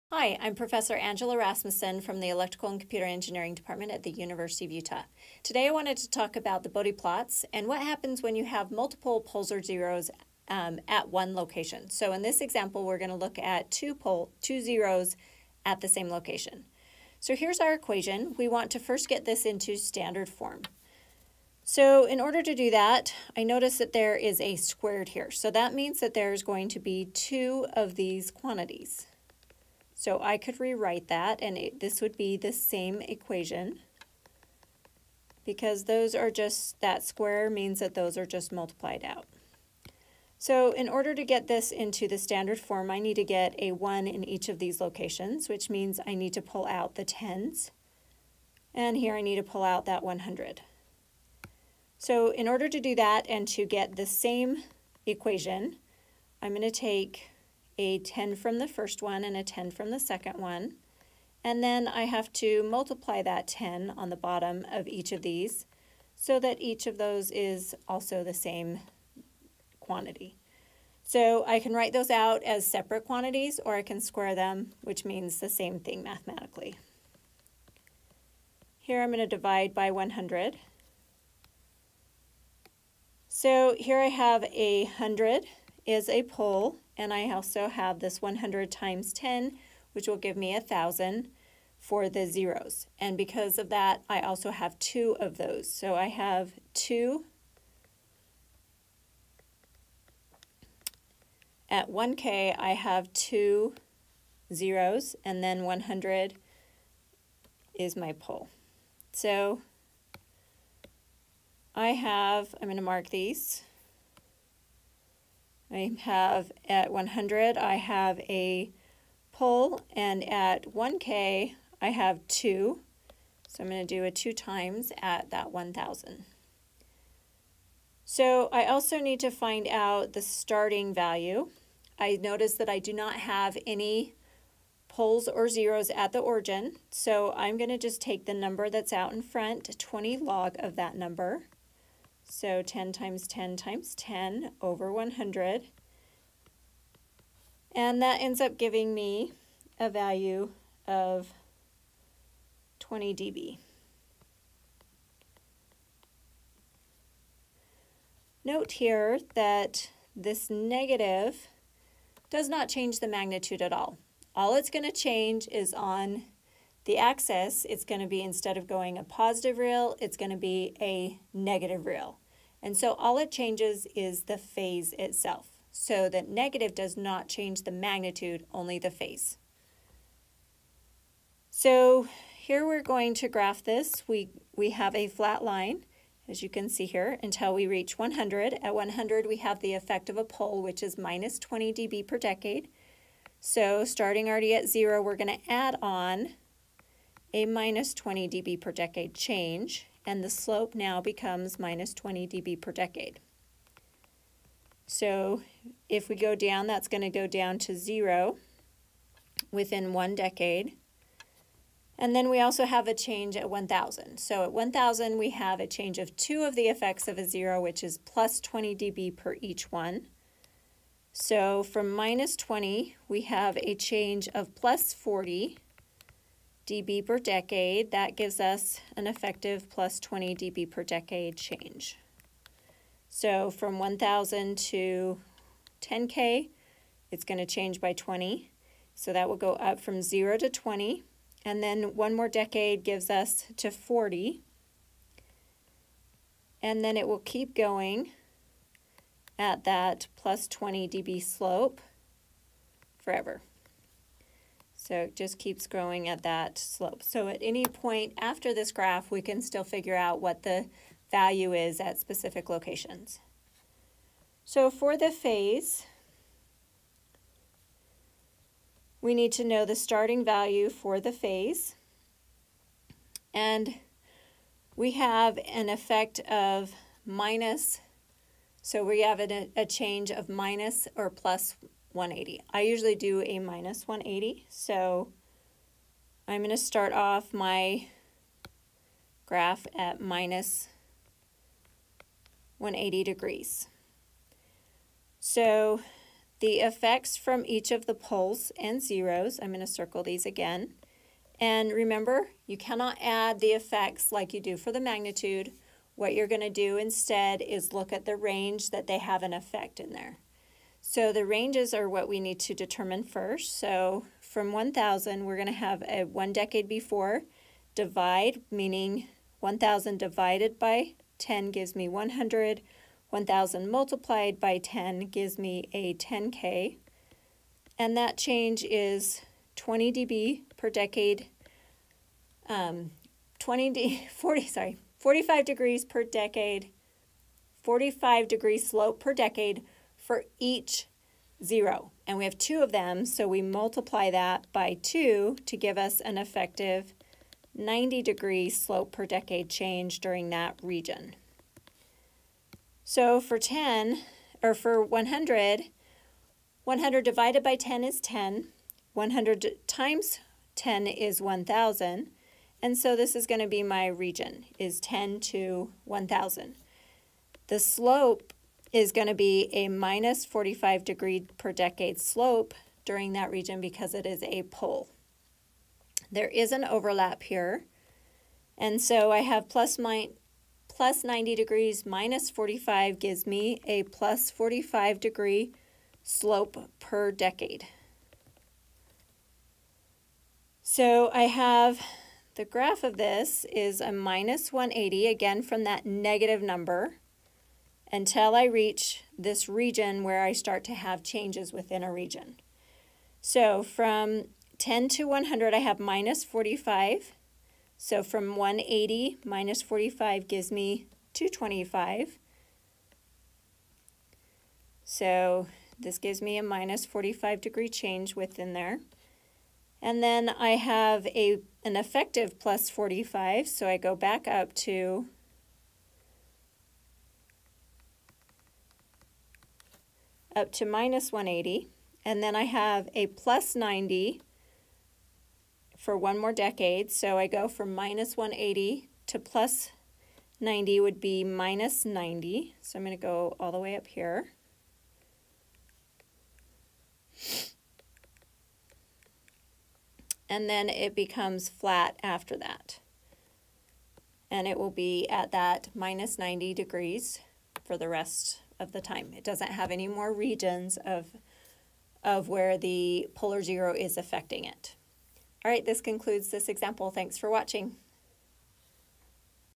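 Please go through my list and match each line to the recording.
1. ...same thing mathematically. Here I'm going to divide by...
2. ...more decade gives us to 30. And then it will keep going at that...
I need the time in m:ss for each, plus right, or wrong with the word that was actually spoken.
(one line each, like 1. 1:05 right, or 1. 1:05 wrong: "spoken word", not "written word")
1. 1:15 right
2. 4:02 wrong: "40", not "30".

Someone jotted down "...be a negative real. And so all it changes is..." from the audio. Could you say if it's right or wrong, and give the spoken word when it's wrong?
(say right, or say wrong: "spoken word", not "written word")
right.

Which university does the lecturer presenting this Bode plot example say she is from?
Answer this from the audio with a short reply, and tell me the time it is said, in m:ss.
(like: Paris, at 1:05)
University of Utah, at 0:04.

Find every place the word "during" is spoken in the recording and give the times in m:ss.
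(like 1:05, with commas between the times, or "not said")
5:49, 6:12.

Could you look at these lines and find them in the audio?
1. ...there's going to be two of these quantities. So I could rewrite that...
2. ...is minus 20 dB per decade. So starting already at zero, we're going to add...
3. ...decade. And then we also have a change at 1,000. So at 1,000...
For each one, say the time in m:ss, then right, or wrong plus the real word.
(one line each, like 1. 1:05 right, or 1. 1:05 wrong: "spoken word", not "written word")
1. 0:26 right
2. 3:10 right
3. 3:30 right.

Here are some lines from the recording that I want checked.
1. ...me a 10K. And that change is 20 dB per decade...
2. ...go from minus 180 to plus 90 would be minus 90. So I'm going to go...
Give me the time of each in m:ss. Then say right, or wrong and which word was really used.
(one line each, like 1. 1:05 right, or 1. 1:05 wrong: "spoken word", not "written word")
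1. 5:25 right
2. 7:17 right.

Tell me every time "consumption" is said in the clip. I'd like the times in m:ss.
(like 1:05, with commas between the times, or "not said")
not said.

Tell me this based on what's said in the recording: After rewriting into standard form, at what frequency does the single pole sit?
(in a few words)
100.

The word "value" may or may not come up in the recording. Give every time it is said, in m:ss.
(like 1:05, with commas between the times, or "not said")
2:10, 2:29, 4:21, 4:30.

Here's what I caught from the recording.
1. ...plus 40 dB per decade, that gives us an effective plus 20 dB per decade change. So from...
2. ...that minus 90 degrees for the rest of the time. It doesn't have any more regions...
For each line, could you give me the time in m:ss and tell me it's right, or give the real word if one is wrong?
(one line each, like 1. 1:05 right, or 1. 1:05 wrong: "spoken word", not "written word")
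1. 3:44 right
2. 7:35 right.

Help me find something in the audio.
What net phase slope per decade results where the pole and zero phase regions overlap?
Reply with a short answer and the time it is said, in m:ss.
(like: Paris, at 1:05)
+45 degrees, at 6:23.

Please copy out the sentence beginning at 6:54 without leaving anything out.
So this gives me a minus 45 degree change within there.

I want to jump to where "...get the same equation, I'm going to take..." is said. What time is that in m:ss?
0:53.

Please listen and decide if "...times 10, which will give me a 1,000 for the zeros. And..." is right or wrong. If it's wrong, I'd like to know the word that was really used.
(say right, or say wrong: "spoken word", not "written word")
right.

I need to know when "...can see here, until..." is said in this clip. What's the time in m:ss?
3:06.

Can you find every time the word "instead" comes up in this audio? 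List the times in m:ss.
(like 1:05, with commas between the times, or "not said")
2:48, 5:06.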